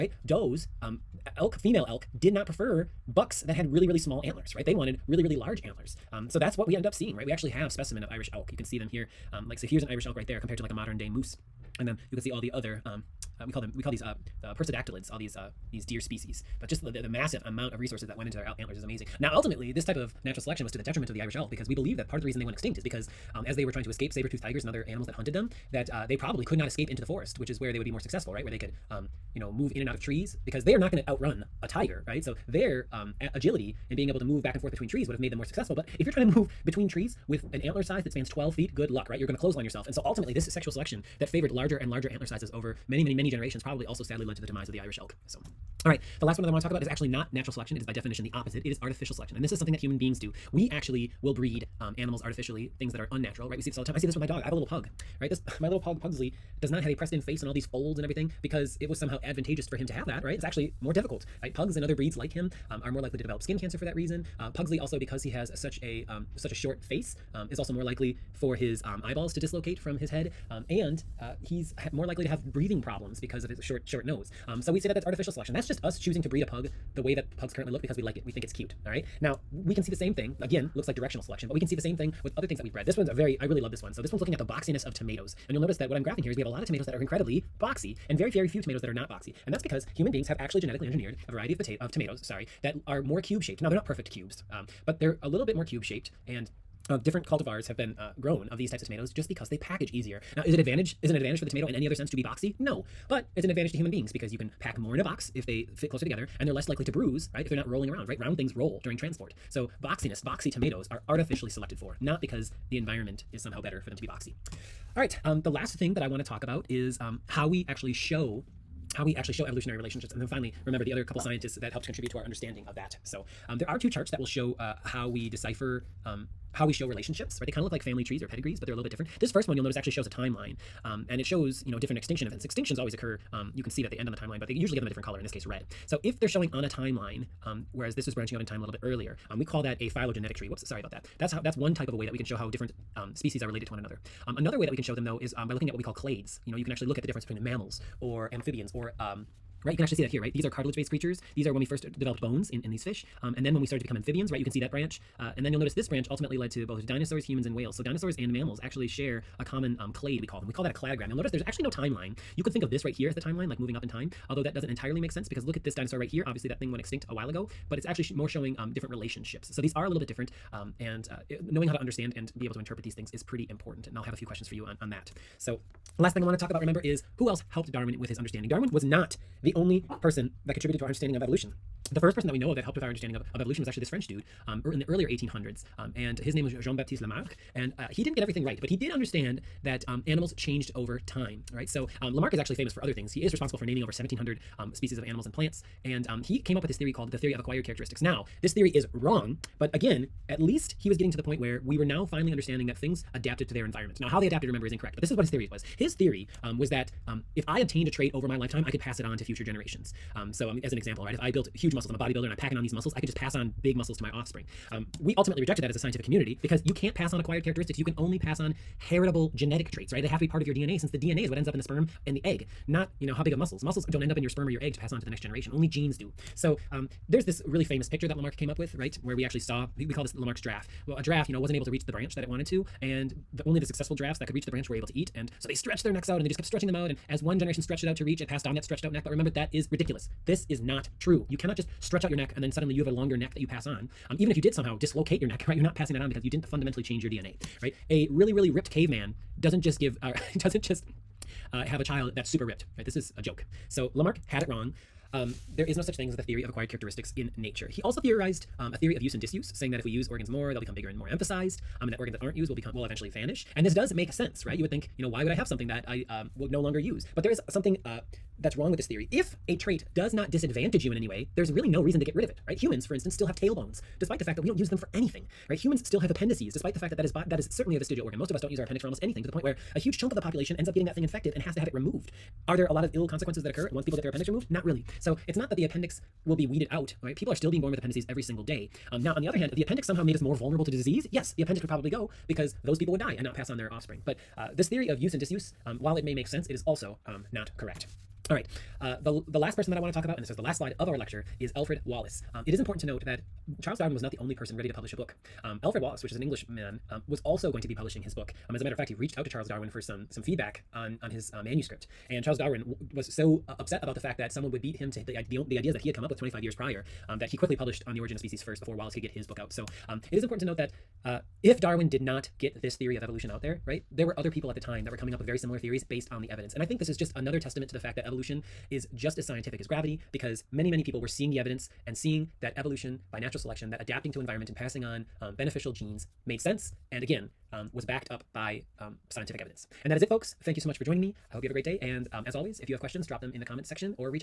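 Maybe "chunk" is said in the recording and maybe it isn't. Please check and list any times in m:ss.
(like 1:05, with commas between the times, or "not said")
4:39.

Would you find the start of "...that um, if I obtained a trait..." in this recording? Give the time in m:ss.
3:26.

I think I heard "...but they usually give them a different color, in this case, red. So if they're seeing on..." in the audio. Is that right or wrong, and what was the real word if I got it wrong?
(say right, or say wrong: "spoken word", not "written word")
wrong: "showing", not "seeing".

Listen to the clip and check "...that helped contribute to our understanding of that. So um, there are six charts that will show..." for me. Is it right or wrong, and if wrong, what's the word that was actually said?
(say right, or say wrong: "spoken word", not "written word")
wrong: "two", not "six".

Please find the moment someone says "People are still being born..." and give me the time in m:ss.
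4:47.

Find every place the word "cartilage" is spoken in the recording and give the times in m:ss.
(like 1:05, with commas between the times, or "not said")
2:30.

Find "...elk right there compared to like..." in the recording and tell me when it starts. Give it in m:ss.
0:10.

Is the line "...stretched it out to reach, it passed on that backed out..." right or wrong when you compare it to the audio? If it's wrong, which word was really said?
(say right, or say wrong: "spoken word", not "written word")
wrong: "stretched", not "backed".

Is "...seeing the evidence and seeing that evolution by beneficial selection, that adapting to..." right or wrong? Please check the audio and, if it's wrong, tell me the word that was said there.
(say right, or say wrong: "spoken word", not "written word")
wrong: "natural", not "beneficial".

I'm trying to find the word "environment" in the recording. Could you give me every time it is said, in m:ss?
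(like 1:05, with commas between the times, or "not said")
1:52, 3:23, 5:34.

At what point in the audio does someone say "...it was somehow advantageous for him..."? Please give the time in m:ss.
0:58.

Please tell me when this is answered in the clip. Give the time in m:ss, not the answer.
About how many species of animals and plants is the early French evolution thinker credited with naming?
3:13.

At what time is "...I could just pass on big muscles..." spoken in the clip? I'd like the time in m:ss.
3:32.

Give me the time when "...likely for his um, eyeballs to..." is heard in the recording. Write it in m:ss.
1:07.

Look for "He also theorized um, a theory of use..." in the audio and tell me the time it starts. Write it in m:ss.
4:17.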